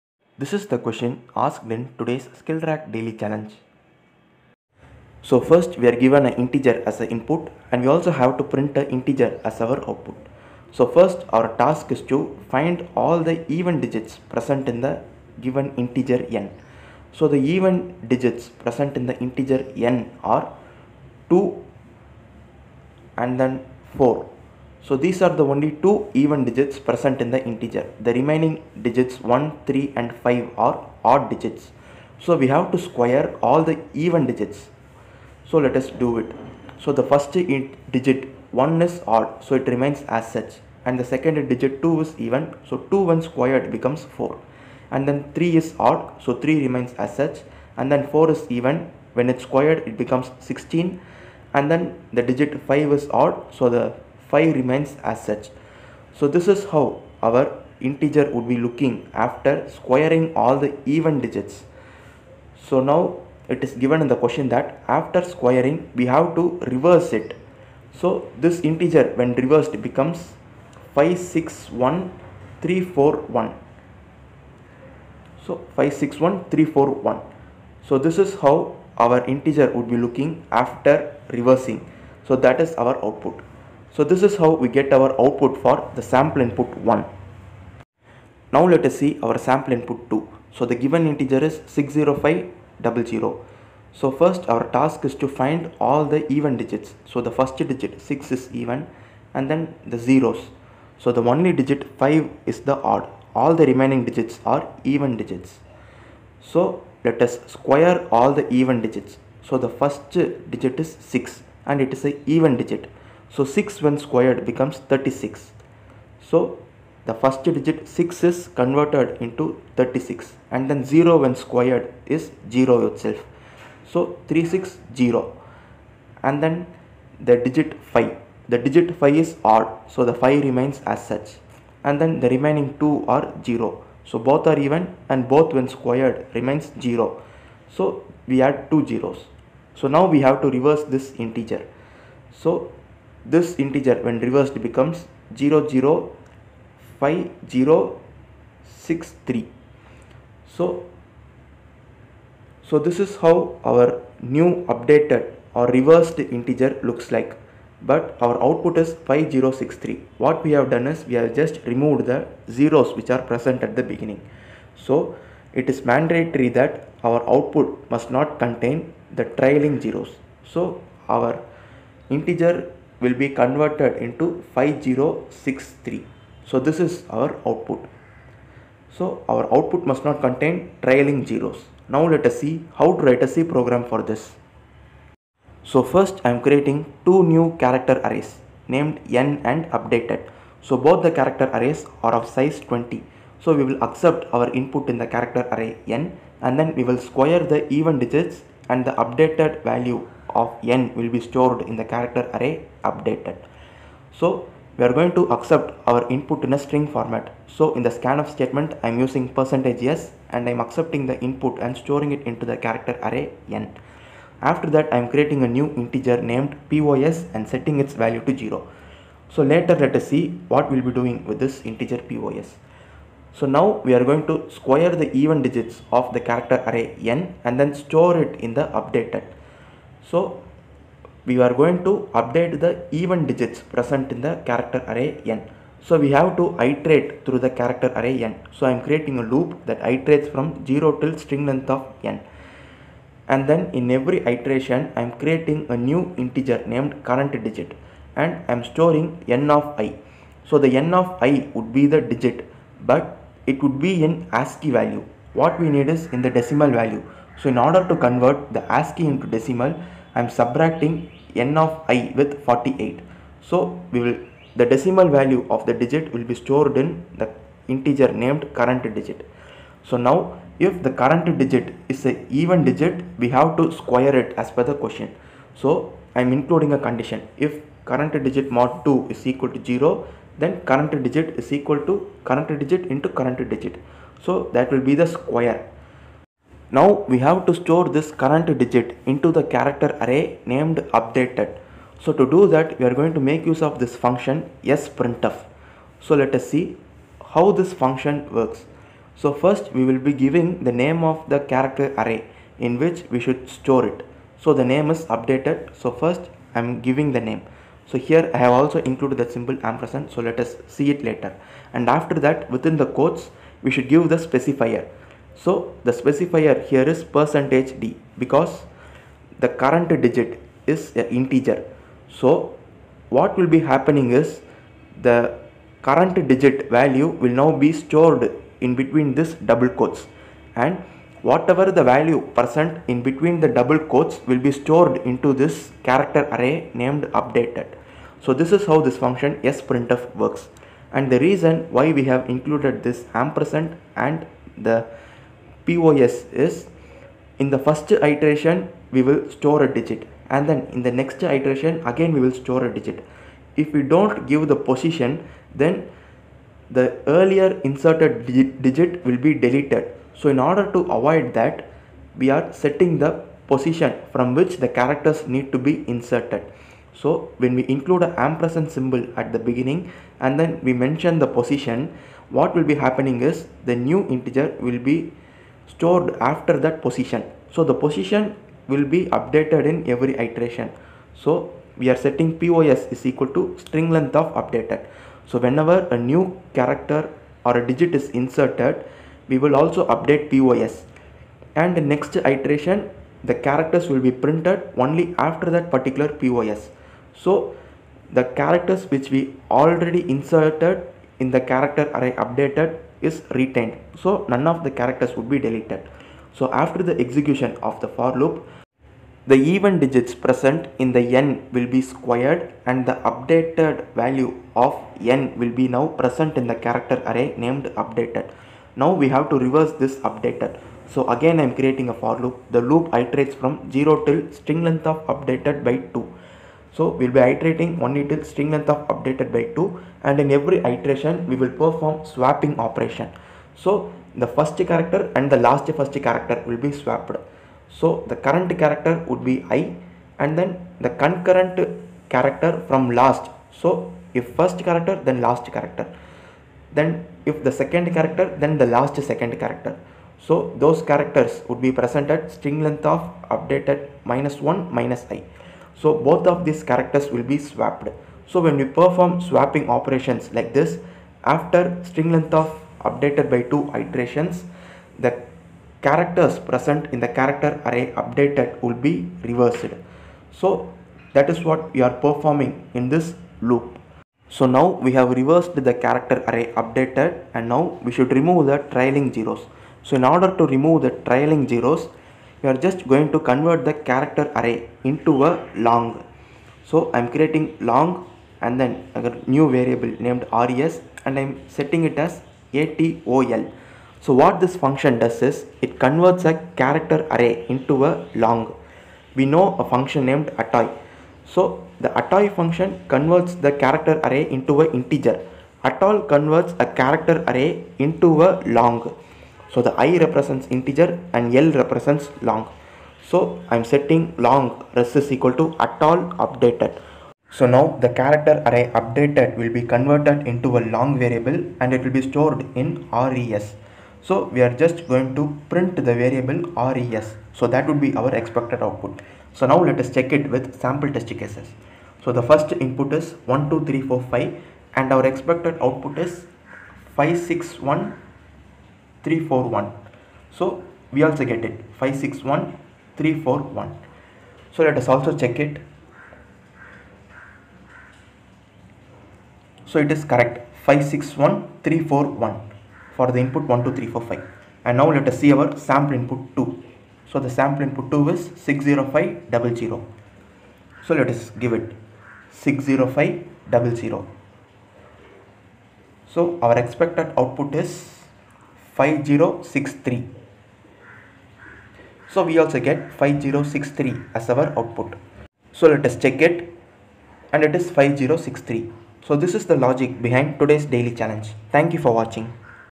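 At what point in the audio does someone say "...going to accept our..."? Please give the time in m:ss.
3:24.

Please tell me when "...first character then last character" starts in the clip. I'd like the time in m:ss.
7:24.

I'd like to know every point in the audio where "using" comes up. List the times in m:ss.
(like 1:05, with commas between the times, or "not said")
3:28.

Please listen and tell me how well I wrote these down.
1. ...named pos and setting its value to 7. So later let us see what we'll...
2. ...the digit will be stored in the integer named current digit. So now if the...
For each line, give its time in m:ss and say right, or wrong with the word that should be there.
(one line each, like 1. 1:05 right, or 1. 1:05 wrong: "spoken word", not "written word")
1. 3:36 wrong: "0", not "7"
2. 4:25 right.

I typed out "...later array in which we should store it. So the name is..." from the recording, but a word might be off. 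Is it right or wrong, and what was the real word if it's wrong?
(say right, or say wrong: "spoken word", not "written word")
wrong: "character", not "later".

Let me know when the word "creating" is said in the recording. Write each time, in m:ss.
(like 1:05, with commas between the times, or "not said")
3:06, 3:35, 3:58, 4:05, 7:01, 8:07.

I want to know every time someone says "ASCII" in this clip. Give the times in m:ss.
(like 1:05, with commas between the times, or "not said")
4:14, 4:18.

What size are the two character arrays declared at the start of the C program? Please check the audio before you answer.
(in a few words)
20.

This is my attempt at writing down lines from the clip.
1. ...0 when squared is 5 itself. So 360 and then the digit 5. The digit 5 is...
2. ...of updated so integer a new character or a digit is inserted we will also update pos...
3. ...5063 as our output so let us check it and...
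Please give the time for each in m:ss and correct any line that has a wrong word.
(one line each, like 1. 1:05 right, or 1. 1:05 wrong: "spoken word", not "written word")
1. 2:00 wrong: "0", not "5"
2. 6:24 wrong: "whenever", not "integer"
3. 9:32 right.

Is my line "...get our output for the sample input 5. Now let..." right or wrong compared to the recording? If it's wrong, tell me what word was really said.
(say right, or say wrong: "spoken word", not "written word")
wrong: "1", not "5".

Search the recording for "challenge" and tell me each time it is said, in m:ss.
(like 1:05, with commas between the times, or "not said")
0:03, 9:41.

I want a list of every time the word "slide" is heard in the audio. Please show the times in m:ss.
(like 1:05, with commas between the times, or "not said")
not said.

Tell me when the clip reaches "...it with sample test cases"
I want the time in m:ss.
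8:50.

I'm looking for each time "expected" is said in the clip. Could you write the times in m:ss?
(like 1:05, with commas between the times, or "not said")
8:48, 8:55, 9:26.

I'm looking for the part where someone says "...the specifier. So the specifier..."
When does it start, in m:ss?
5:14.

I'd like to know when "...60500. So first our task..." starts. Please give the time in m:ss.
1:31.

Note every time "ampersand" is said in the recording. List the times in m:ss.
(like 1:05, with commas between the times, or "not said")
5:09, 5:43, 6:08.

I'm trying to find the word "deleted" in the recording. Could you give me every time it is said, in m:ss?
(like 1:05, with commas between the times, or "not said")
5:59, 6:45.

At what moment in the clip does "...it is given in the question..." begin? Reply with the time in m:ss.
1:03.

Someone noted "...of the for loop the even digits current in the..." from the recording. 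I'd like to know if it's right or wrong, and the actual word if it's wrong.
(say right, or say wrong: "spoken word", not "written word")
wrong: "present", not "current".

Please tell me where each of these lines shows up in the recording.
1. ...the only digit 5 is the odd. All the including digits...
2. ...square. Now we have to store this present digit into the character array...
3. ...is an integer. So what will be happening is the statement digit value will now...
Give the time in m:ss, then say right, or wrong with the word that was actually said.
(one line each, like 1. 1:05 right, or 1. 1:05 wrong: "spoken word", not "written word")
1. 1:41 wrong: "remaining", not "including"
2. 4:45 wrong: "current", not "present"
3. 5:20 wrong: "current", not "statement".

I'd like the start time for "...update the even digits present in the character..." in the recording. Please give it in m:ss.
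3:52.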